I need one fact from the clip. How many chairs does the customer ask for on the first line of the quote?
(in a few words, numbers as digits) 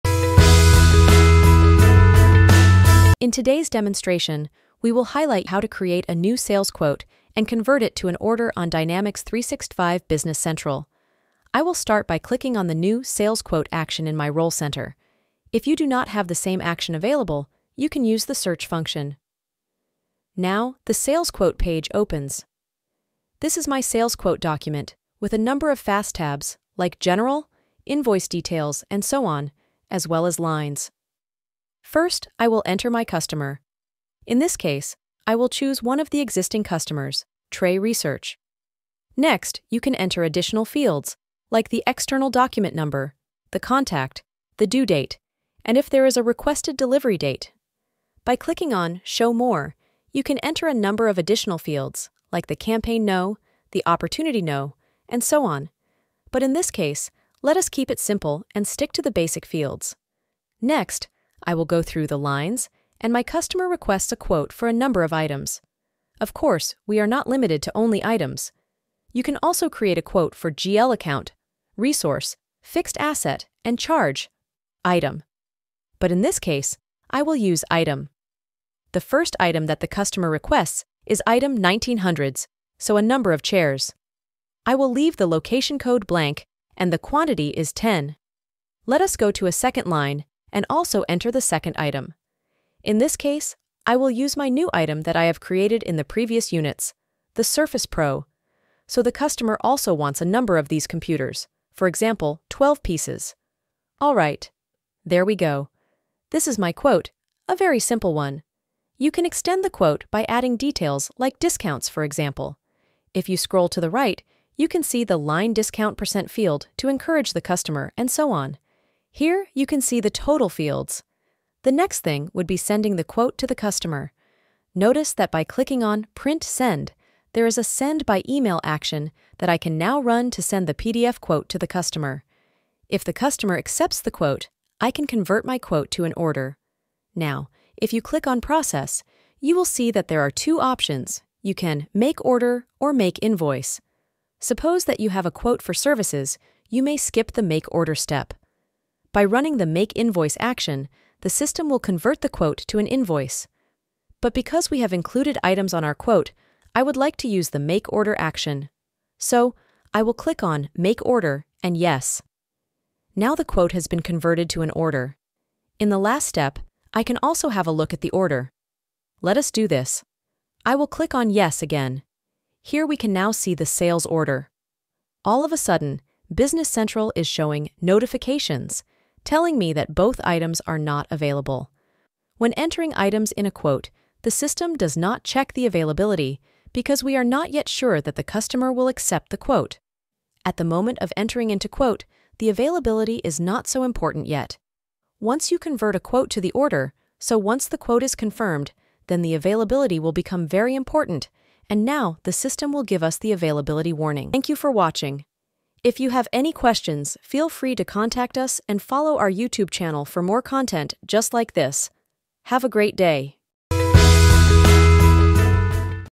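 10.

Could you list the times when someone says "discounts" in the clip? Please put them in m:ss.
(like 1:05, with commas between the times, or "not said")
1:51, 1:55.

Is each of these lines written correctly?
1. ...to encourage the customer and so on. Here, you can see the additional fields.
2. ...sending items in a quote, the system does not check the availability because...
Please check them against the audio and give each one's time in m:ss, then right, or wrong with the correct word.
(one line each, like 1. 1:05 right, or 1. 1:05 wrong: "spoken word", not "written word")
1. 1:56 wrong: "total", not "additional"
2. 3:02 wrong: "entering", not "sending".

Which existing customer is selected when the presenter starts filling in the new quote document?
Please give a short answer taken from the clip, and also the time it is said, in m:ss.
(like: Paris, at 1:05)
Trey Research, at 0:37.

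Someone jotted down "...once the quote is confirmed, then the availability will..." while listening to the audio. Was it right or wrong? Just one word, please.
right.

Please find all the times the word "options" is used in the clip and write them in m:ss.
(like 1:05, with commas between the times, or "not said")
2:20.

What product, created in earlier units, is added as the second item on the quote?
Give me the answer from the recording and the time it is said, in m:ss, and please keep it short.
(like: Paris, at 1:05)
Surface Pro, at 1:37.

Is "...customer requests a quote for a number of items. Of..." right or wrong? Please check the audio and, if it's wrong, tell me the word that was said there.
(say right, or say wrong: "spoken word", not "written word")
right.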